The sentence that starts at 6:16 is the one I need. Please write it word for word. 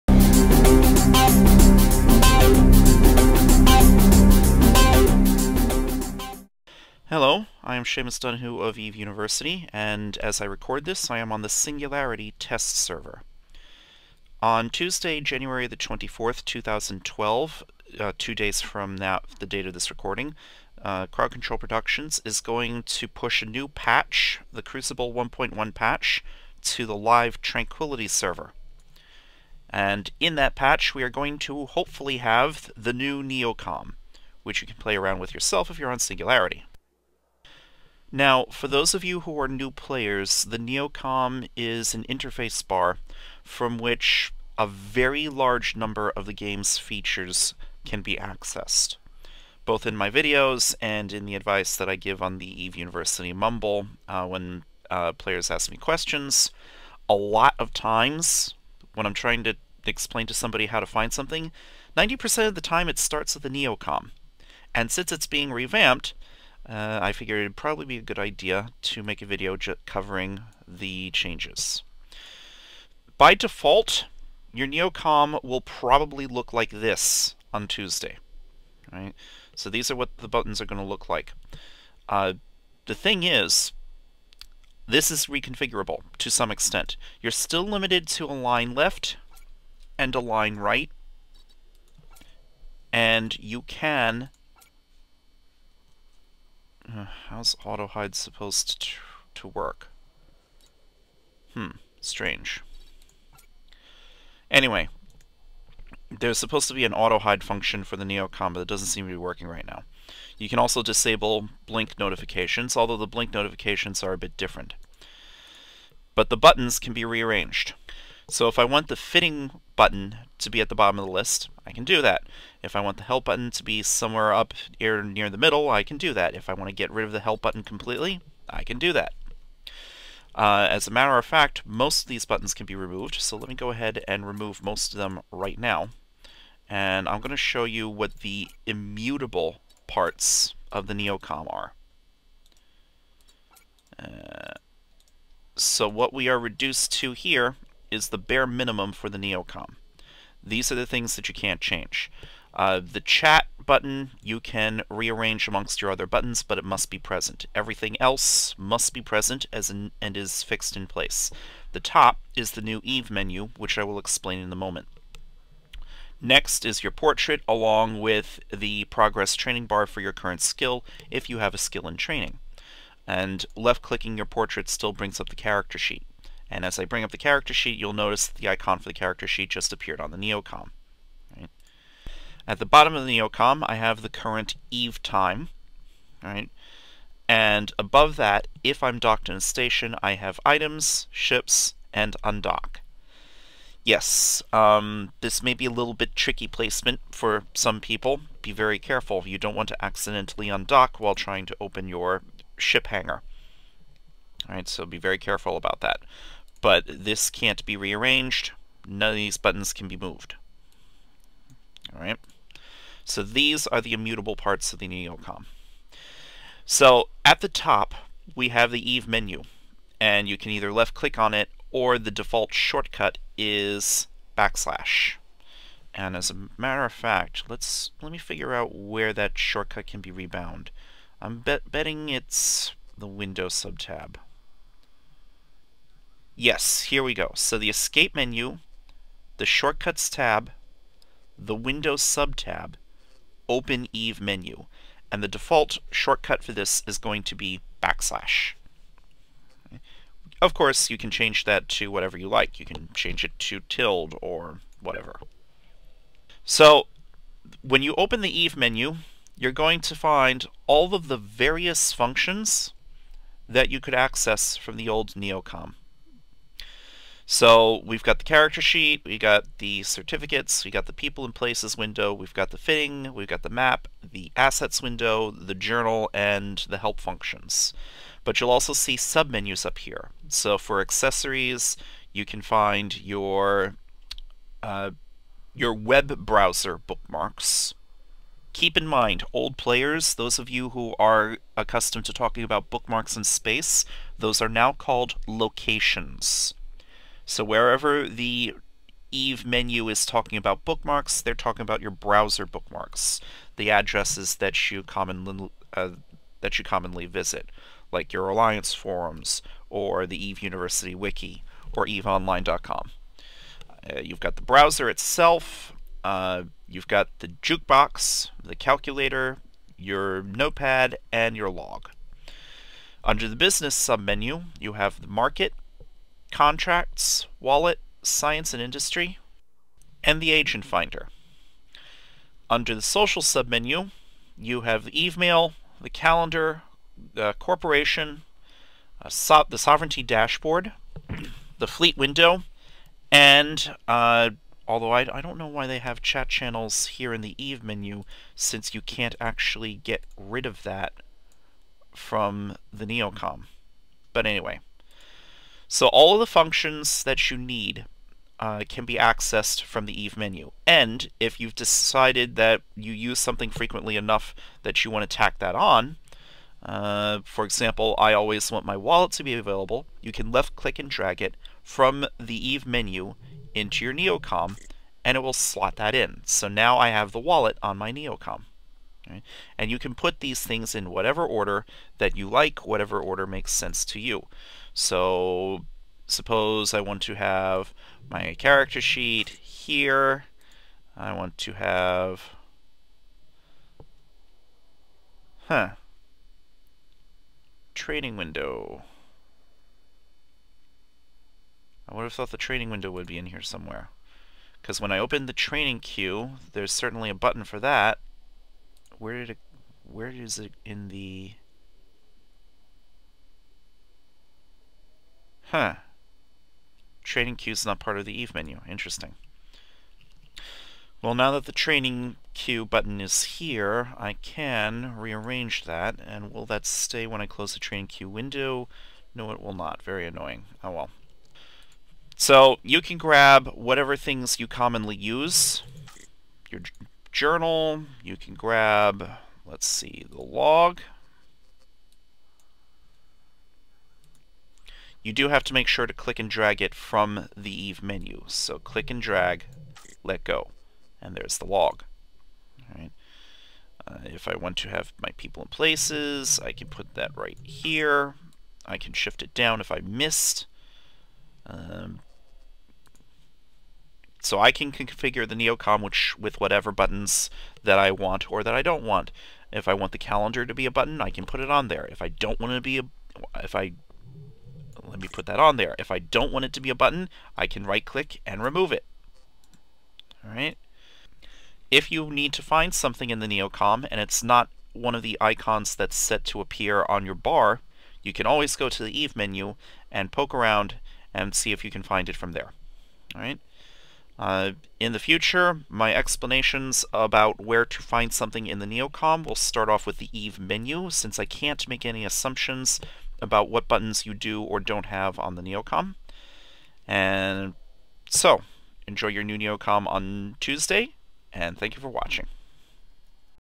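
So now I have the wallet on my Neocom.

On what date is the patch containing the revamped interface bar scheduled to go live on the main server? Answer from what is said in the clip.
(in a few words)
January 24th, 2012.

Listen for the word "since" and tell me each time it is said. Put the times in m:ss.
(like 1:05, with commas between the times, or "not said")
1:04, 5:48, 8:20.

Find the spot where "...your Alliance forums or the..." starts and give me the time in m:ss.
5:08.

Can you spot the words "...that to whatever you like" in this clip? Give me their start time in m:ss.
4:11.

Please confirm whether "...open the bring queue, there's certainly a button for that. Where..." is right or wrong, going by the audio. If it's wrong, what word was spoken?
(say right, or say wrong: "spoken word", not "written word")
wrong: "training", not "bring".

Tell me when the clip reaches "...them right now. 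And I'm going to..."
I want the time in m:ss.
2:14.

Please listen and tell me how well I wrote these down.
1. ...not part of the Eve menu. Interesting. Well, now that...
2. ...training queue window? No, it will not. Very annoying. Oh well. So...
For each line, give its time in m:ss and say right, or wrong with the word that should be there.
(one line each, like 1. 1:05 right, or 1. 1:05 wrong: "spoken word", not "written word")
1. 6:57 right
2. 7:07 right.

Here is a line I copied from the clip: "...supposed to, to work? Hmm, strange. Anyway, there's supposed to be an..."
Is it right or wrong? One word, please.
right.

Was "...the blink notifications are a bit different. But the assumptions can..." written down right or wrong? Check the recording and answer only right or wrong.
wrong.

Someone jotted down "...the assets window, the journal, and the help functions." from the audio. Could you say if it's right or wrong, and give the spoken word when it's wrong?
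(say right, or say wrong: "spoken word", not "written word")
right.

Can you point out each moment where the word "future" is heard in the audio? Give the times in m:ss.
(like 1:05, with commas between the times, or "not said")
8:14.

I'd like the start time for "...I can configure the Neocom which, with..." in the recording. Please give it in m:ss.
7:44.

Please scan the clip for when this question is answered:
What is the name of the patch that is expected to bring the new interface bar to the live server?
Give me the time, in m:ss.
0:24.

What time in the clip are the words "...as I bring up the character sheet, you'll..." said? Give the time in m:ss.
2:56.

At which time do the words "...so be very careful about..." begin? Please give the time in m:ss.
3:24.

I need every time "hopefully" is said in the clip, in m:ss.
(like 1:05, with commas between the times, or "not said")
0:31.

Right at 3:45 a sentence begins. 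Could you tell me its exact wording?
And as a matter of fact, let's let me figure out where that shortcut can be rebound.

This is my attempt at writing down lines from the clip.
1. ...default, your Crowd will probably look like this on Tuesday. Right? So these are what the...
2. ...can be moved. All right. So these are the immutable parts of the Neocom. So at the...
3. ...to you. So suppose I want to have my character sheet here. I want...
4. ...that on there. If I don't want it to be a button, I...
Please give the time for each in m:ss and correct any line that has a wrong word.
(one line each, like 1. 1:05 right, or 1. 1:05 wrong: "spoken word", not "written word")
1. 1:13 wrong: "Neocom", not "Crowd"
2. 3:29 right
3. 6:23 right
4. 7:55 right.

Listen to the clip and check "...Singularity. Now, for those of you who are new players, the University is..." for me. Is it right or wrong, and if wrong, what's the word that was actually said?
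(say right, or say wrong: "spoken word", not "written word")
wrong: "Neocom", not "University".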